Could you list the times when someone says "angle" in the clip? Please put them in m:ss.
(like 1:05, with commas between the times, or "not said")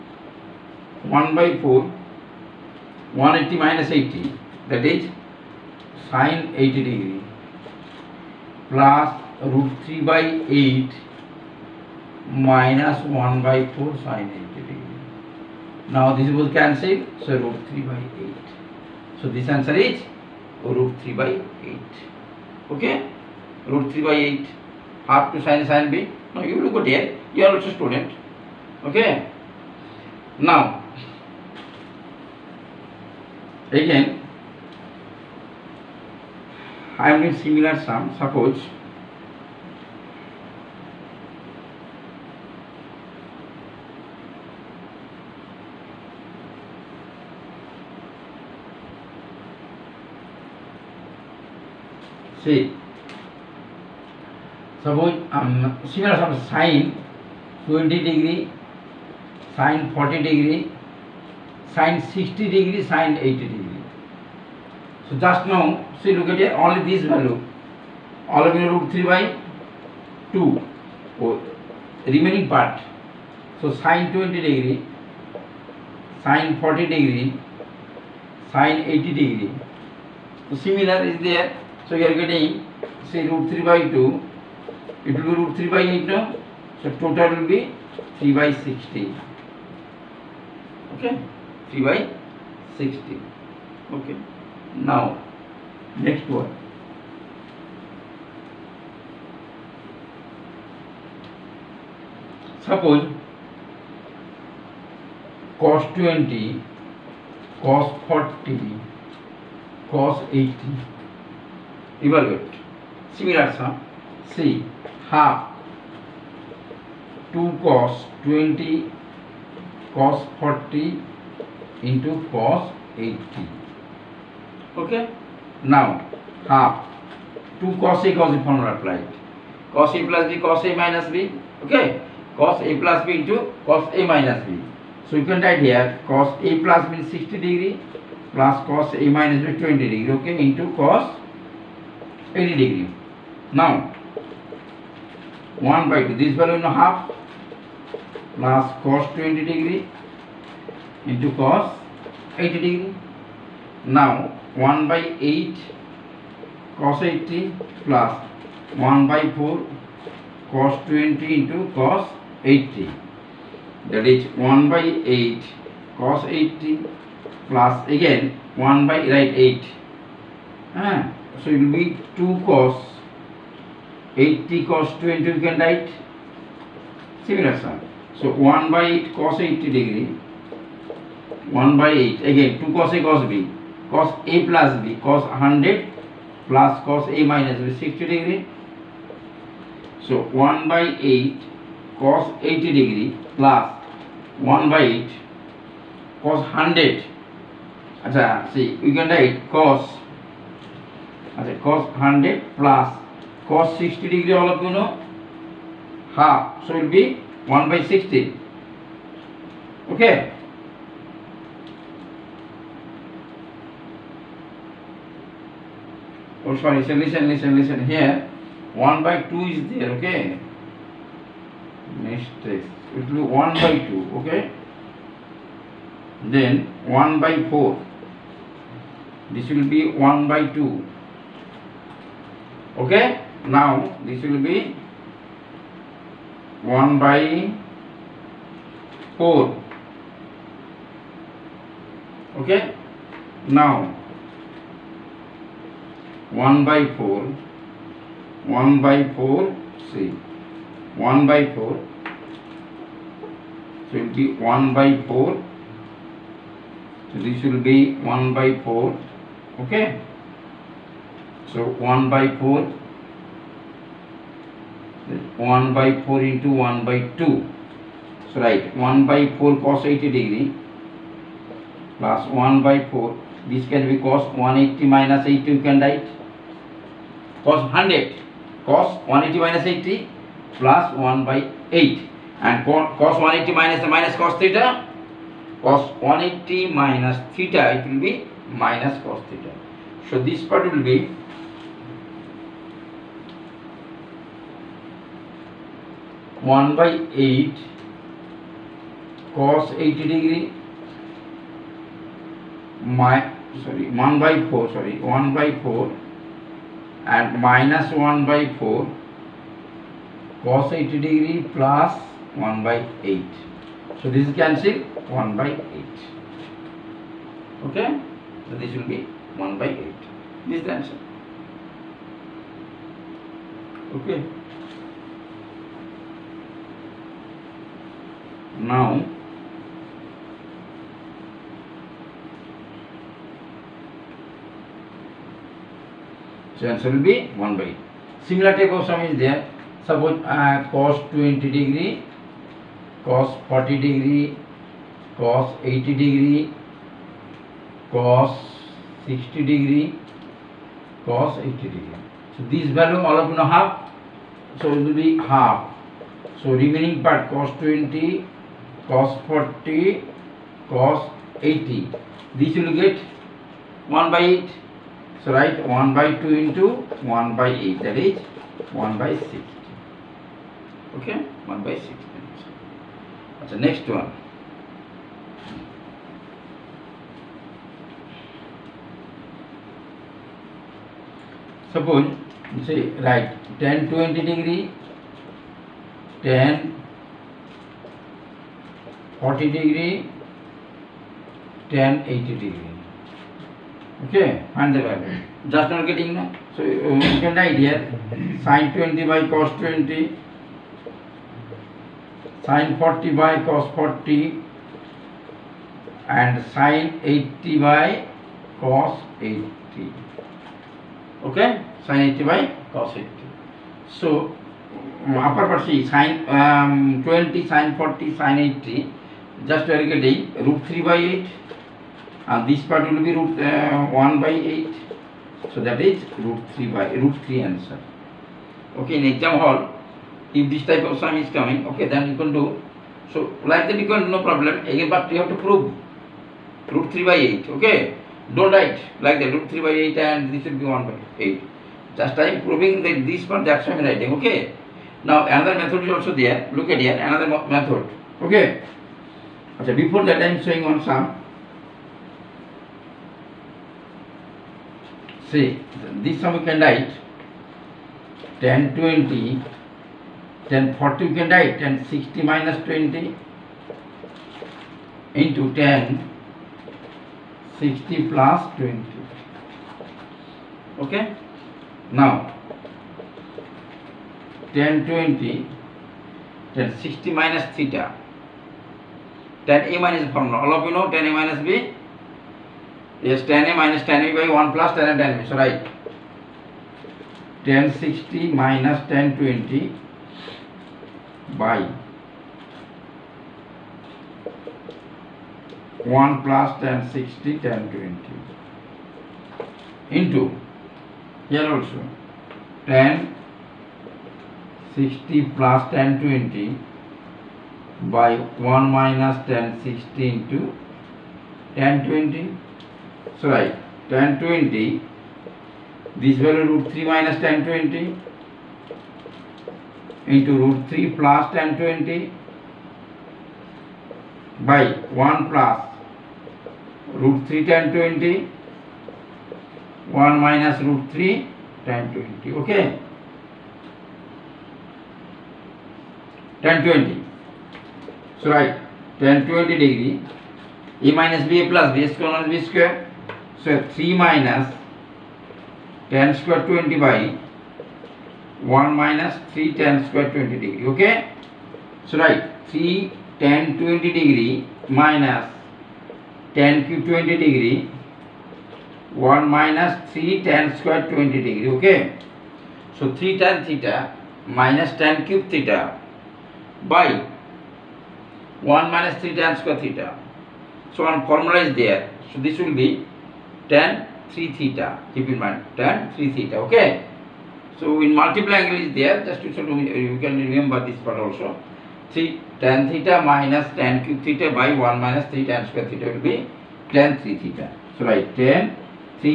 9:38.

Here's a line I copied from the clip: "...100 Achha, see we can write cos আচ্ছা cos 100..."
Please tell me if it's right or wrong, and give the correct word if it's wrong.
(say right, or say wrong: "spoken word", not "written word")
right.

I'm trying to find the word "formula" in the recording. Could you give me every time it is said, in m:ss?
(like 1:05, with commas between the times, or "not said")
2:08, 8:00, 9:31.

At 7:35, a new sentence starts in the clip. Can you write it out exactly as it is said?
See, this sum we can write 10, 20, 10, 40 we can write, 10, 60 minus 20 into 10, 60 plus 20.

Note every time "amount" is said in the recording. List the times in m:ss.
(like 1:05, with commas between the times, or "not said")
not said.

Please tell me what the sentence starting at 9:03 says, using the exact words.
So 3 minus tan square 20 by 1 minus 3 tan square 20 degree.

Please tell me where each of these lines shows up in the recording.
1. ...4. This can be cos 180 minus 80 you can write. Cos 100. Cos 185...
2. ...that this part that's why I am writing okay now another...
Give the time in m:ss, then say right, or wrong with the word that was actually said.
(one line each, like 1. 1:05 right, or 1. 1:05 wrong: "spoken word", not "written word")
1. 4:32 wrong: "180", not "185"
2. 7:22 right.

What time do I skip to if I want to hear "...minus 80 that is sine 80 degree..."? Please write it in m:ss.
0:03.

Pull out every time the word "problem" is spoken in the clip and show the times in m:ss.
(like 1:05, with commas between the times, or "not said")
7:14.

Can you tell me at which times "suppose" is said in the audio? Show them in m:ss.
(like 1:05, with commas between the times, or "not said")
0:38, 0:54, 1:42, 5:39, 6:21.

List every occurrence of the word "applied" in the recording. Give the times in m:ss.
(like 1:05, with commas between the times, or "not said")
2:08.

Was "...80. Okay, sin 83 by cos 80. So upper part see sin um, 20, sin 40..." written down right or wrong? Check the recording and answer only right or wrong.
wrong.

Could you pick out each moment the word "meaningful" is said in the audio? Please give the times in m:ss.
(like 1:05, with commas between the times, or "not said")
not said.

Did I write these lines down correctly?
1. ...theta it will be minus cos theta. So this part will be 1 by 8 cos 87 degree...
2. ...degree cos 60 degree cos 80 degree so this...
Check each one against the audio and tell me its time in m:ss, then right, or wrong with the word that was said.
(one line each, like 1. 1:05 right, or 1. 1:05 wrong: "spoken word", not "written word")
1. 4:47 wrong: "80", not "87"
2. 5:46 right.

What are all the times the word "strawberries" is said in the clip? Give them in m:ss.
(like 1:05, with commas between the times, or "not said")
not said.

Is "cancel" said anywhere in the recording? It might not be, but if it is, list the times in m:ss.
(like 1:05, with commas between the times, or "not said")
0:16, 5:14.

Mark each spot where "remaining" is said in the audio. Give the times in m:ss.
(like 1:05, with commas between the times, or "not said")
1:12, 5:56.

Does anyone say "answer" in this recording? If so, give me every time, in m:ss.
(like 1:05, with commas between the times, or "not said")
0:19, 5:20, 5:36, 7:07.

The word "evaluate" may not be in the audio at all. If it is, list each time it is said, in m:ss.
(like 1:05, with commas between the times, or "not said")
1:52.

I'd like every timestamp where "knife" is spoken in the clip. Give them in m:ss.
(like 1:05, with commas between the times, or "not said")
not said.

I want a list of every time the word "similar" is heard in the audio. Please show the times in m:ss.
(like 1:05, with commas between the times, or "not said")
0:37, 0:55, 1:20, 1:53, 2:57, 5:38.